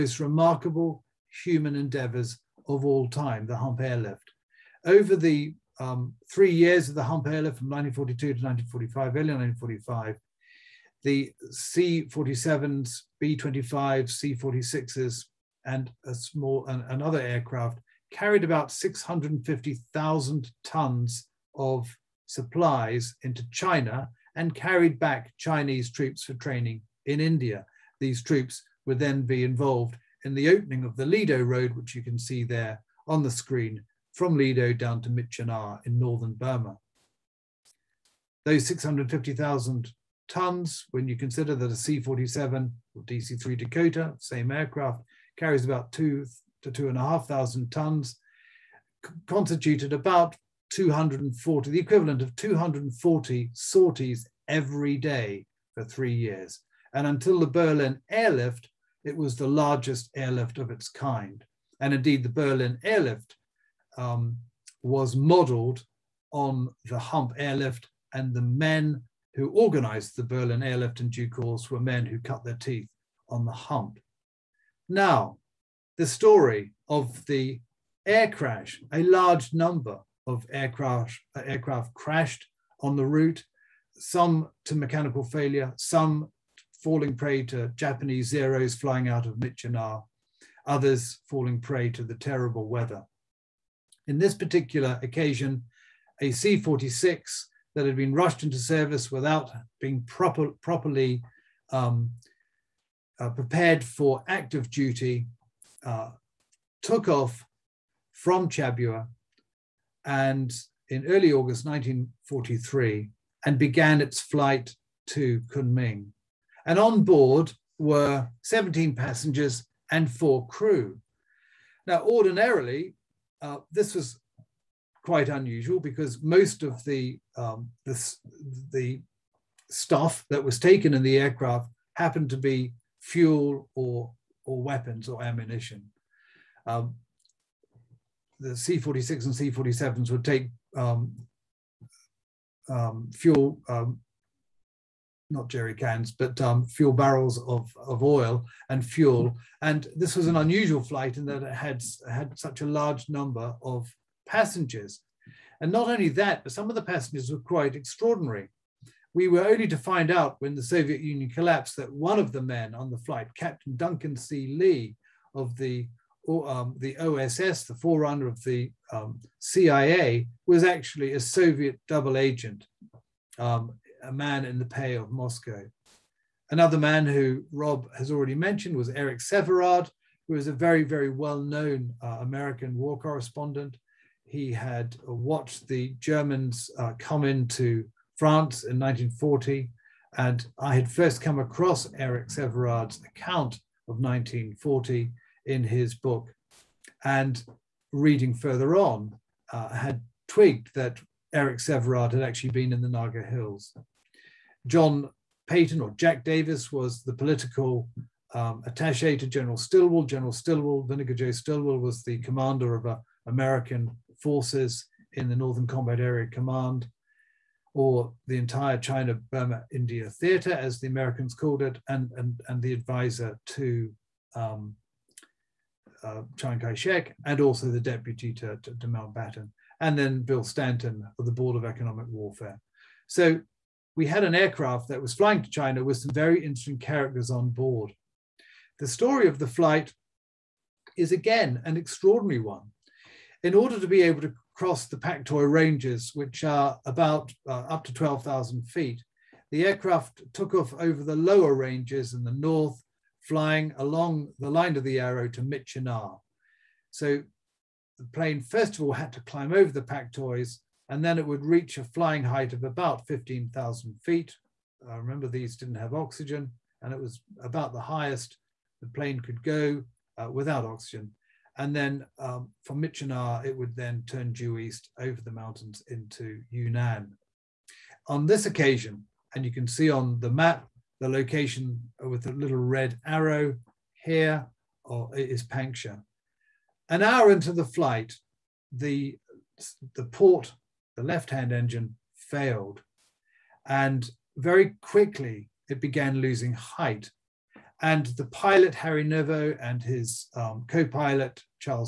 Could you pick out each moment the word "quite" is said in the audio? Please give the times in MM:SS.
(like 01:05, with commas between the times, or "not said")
02:05, 02:37.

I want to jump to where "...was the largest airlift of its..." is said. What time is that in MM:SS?
00:59.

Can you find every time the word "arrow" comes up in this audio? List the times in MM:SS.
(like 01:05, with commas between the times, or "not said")
04:14, 04:43.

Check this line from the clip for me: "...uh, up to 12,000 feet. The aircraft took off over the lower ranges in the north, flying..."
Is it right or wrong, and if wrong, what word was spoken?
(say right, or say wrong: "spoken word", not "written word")
right.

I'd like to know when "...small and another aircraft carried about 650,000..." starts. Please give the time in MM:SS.
00:16.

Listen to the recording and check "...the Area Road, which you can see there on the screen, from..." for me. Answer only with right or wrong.
wrong.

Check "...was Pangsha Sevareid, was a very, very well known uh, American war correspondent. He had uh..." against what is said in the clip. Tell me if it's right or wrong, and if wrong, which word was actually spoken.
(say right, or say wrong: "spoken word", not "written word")
wrong: "Eric", not "Pangsha".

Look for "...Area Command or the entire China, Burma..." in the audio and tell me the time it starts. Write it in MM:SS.
03:36.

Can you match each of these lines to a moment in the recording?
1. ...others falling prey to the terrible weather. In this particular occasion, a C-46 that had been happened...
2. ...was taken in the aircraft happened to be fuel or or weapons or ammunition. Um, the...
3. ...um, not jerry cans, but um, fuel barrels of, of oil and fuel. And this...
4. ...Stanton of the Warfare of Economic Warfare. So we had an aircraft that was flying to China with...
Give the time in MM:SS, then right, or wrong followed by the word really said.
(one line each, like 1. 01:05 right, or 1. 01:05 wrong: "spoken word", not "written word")
1. 01:30 wrong: "rushed", not "happened"
2. 02:10 right
3. 02:23 right
4. 03:50 wrong: "Board", not "Warfare".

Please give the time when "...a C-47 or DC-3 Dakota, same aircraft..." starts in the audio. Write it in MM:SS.
00:41.